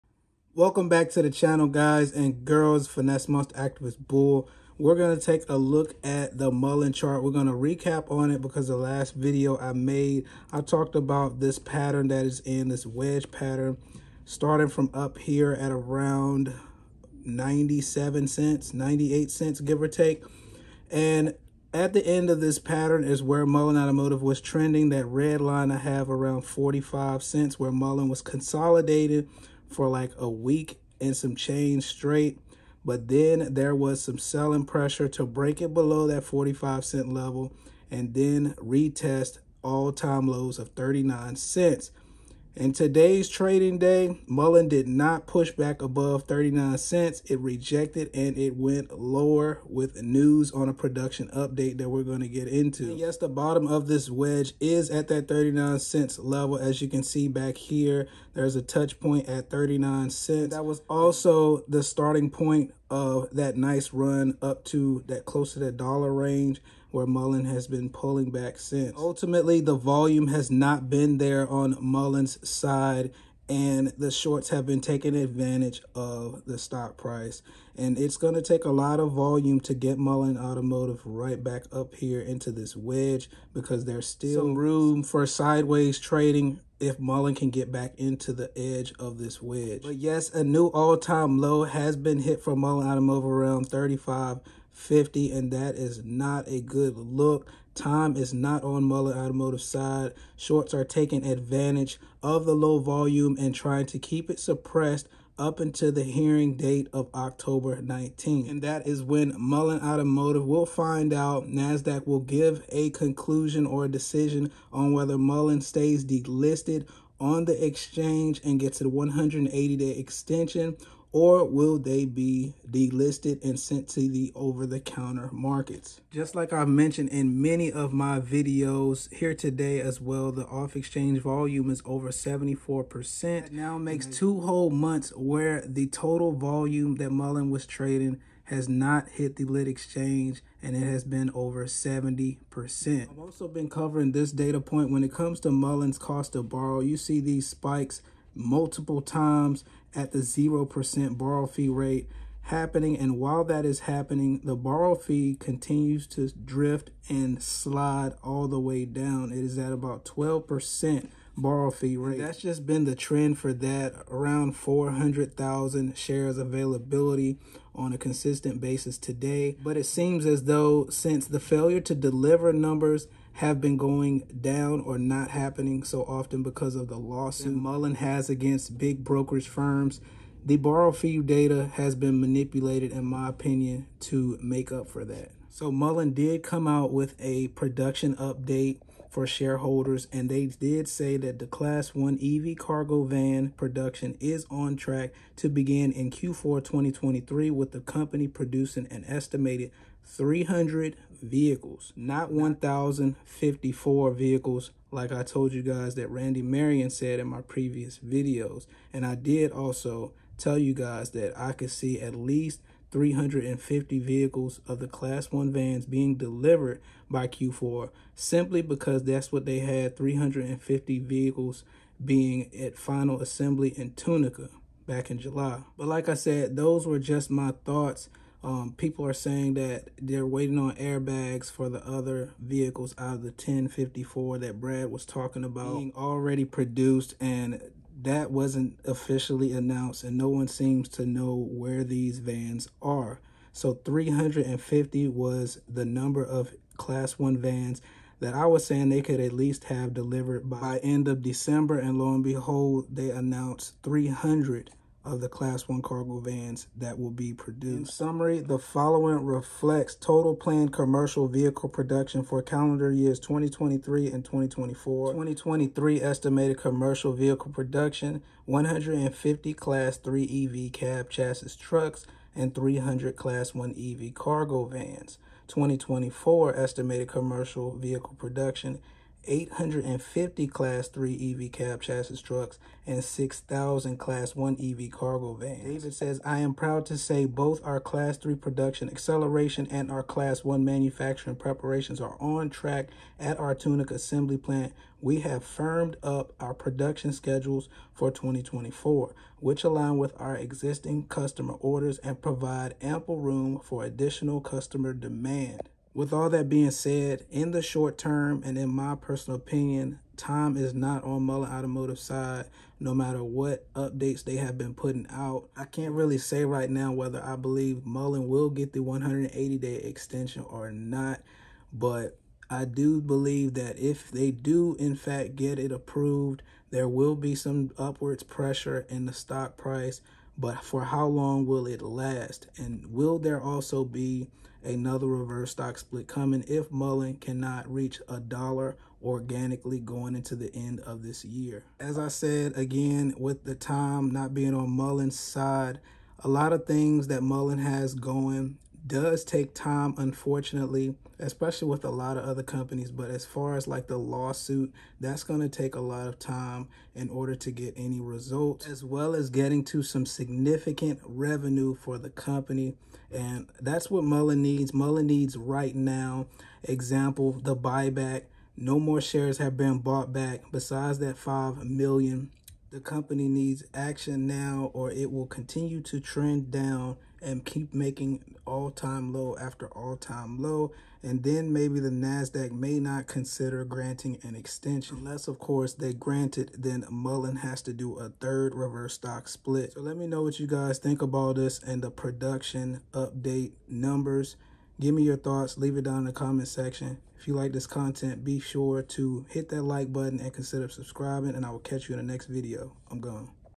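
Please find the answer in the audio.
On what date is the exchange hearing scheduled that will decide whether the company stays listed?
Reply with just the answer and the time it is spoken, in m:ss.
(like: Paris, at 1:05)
October 19th, at 1:47.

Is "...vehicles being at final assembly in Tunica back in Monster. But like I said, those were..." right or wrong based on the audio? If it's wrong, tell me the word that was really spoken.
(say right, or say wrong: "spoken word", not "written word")
wrong: "July", not "Monster".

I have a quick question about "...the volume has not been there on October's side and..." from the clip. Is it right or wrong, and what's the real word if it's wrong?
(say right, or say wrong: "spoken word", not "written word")
wrong: "Mullen", not "October".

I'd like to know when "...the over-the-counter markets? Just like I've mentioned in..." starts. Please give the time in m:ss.
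2:04.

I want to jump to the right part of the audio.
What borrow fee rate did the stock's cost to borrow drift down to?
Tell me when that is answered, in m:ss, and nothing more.
2:40.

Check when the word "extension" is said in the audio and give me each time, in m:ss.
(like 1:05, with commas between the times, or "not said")
1:59, 5:19, 6:24.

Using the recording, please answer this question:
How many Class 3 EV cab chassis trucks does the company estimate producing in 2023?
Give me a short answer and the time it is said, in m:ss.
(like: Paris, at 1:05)
150, at 4:28.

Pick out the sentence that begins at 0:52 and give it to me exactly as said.
And yes, the bottom of this wedge is at that 39 cents level.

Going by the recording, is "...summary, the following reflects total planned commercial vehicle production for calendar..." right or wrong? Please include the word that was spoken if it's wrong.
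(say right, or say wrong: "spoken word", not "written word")
right.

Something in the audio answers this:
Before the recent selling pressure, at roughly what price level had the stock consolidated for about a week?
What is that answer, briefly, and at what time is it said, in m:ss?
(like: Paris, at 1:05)
45 cents, at 0:26.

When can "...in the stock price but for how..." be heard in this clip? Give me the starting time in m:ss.
5:28.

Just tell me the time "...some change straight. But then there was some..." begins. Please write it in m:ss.
0:31.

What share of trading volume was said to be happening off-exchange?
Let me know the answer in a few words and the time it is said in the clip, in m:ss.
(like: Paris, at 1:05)
over 74%, at 2:11.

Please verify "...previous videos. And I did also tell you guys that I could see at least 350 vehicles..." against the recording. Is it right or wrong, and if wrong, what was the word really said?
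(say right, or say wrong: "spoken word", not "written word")
right.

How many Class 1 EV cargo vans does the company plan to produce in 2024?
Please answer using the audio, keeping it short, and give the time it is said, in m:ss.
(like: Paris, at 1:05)
6,000, at 4:43.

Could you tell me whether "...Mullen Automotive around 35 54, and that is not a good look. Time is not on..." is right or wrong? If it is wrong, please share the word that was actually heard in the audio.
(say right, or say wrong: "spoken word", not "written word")
wrong: "50", not "54".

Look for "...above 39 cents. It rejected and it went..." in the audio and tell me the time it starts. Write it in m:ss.
0:45.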